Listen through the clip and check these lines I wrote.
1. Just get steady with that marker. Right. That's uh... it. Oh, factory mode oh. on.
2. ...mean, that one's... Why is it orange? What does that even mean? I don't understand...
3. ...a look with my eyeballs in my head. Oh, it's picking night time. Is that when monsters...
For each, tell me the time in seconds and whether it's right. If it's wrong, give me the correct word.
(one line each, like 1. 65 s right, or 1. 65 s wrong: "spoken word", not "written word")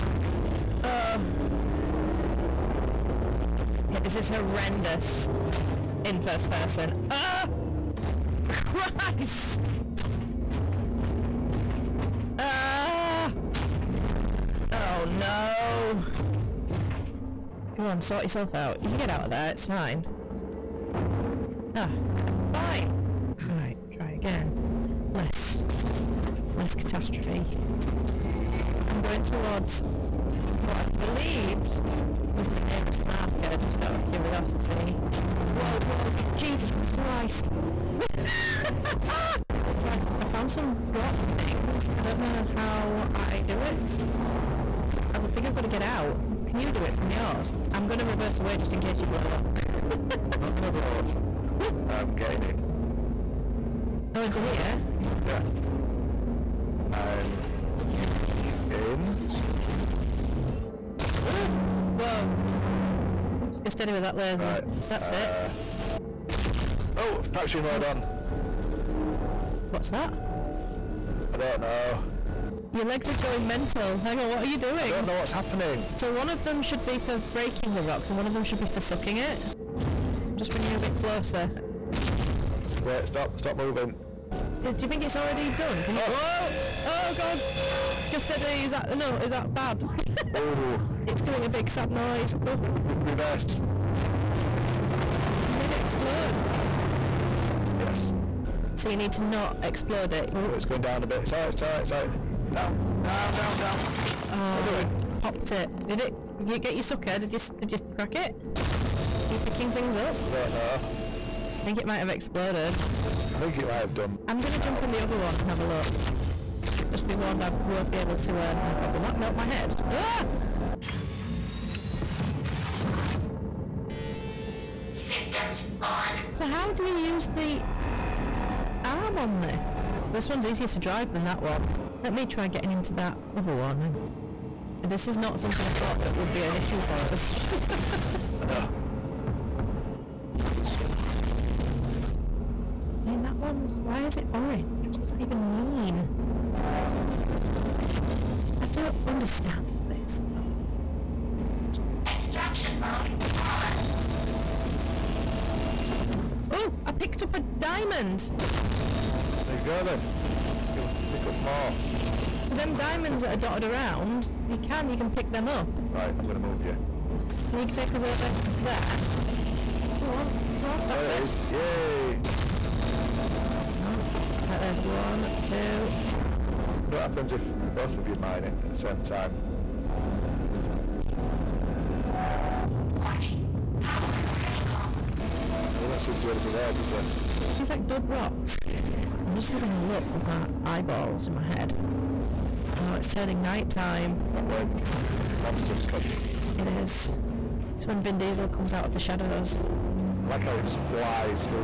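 1. 63 s wrong: "laser", not "marker"
2. 143 s right
3. 189 s wrong: "turning", not "picking".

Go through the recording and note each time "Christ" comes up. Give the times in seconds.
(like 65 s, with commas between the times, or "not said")
8 s, 36 s.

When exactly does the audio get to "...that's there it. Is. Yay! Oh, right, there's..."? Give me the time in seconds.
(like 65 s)
170 s.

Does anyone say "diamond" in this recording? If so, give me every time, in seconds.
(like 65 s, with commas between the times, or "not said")
157 s, 162 s.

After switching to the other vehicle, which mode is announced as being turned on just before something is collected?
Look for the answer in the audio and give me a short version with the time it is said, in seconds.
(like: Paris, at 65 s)
Extraction mode, at 152 s.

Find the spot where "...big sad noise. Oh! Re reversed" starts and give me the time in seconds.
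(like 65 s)
91 s.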